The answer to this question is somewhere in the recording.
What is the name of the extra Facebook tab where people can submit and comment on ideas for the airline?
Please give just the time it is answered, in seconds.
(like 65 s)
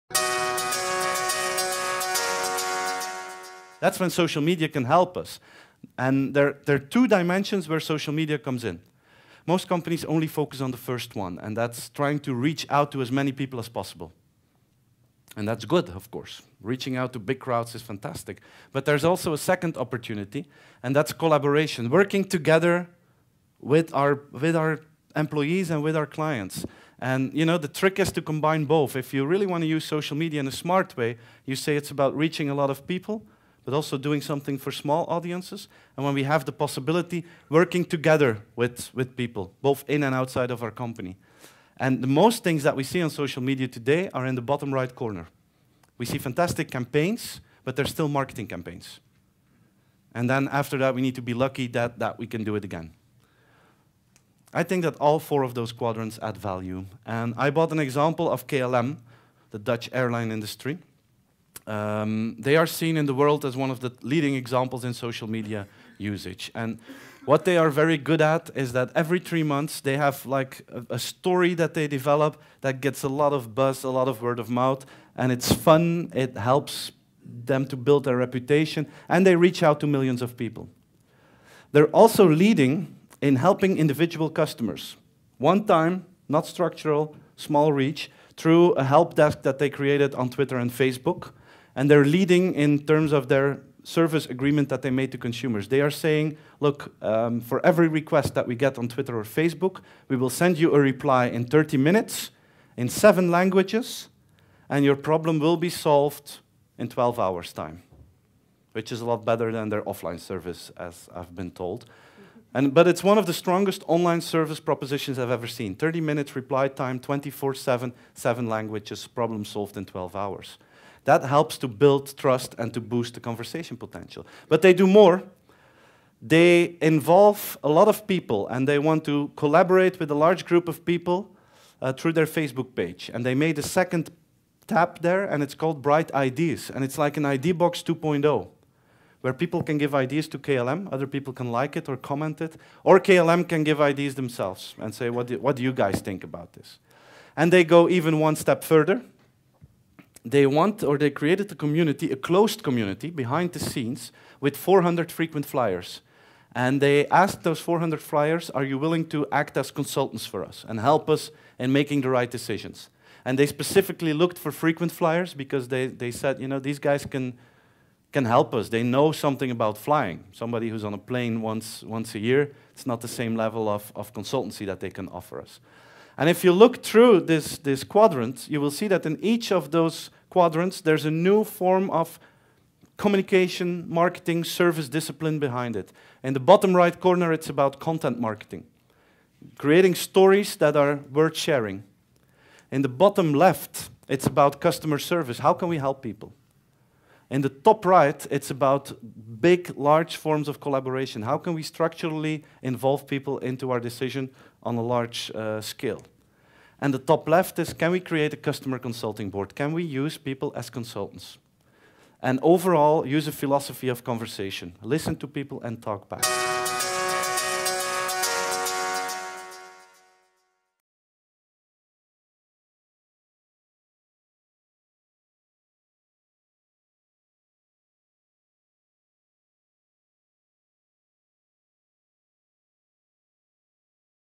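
135 s.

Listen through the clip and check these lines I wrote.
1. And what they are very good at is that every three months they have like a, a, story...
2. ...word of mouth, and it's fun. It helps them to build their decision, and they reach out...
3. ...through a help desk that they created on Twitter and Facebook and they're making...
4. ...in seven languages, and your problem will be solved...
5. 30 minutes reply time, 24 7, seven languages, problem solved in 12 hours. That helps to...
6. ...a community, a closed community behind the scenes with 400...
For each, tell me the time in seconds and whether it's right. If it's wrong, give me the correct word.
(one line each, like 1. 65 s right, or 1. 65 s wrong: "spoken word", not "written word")
1. 66 s right
2. 74 s wrong: "reputation", not "decision"
3. 88 s wrong: "leading", not "making"
4. 102 s right
5. 115 s right
6. 151 s right.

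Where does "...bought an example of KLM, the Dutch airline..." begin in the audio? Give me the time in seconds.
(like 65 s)
57 s.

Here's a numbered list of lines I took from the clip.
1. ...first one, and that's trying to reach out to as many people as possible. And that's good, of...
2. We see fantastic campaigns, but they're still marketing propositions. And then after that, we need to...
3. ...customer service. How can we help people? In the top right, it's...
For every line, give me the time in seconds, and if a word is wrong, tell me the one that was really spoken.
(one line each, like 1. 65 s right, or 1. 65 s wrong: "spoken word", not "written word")
1. 10 s right
2. 45 s wrong: "campaigns", not "propositions"
3. 194 s right.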